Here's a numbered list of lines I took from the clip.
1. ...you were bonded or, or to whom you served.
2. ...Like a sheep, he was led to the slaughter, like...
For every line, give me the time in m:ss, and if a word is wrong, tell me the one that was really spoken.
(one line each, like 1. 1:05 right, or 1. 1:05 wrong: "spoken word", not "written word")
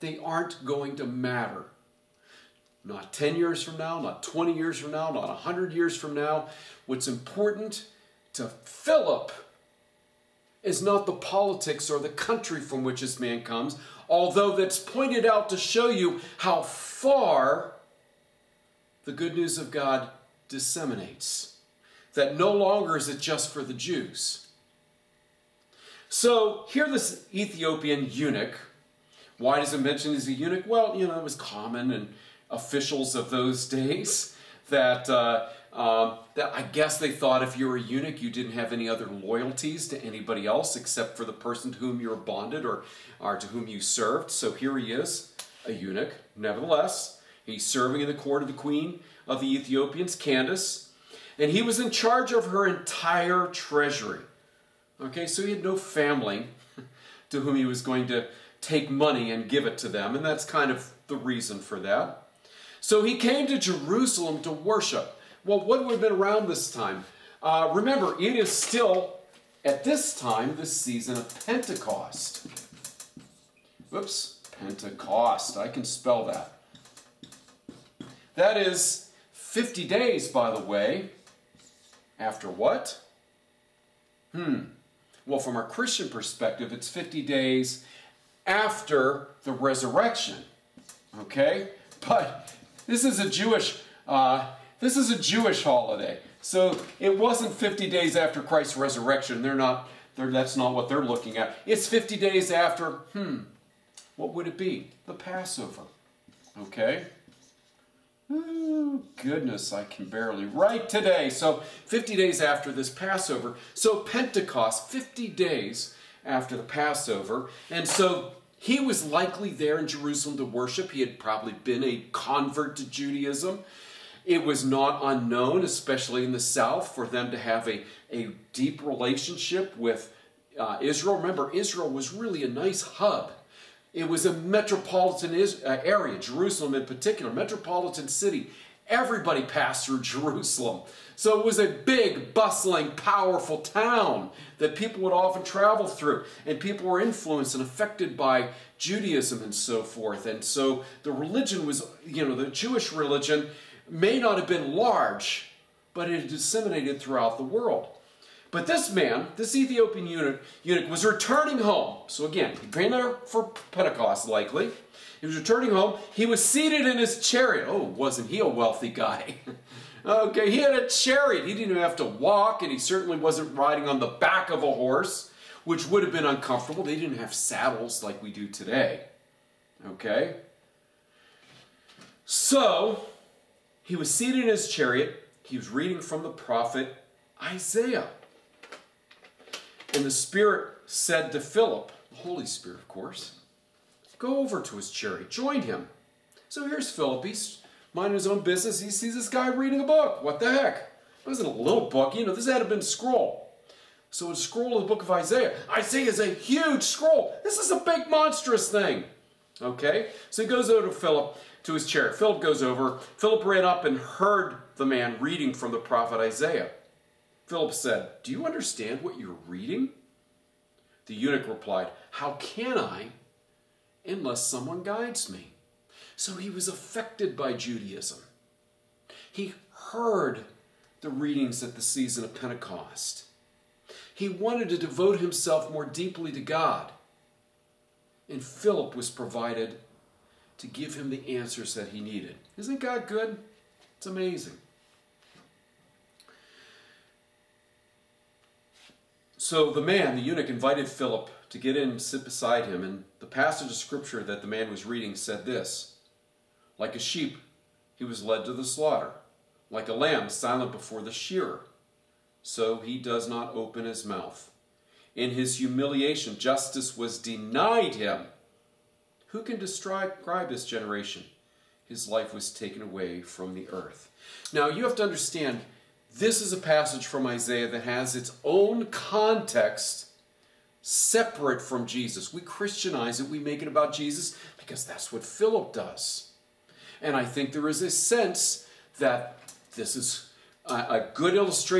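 1. 0:42 right
2. 4:16 right.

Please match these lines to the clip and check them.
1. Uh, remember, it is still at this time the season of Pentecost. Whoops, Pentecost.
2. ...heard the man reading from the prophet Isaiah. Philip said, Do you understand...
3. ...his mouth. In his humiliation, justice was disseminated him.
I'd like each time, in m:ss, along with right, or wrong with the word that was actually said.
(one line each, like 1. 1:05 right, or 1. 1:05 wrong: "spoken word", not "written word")
1. 1:07 right
2. 3:33 right
3. 4:23 wrong: "denied", not "disseminated".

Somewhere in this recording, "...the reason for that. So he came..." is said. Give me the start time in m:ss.
1:01.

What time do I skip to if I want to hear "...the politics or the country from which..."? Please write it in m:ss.
0:11.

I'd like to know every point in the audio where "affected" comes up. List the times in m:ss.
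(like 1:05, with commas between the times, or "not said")
2:27, 3:46.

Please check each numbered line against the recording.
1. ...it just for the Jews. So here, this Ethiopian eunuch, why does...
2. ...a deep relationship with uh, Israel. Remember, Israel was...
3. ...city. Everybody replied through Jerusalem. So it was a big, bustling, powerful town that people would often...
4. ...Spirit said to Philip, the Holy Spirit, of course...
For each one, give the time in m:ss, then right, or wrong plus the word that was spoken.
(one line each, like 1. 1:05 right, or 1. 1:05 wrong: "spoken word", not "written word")
1. 0:23 right
2. 2:08 right
3. 2:18 wrong: "passed", not "replied"
4. 3:10 right.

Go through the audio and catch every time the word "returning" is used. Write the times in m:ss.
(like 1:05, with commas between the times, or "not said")
2:41, 2:45.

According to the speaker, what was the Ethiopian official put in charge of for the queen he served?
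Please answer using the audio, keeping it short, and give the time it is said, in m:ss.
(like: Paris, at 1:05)
Her entire treasury, at 0:52.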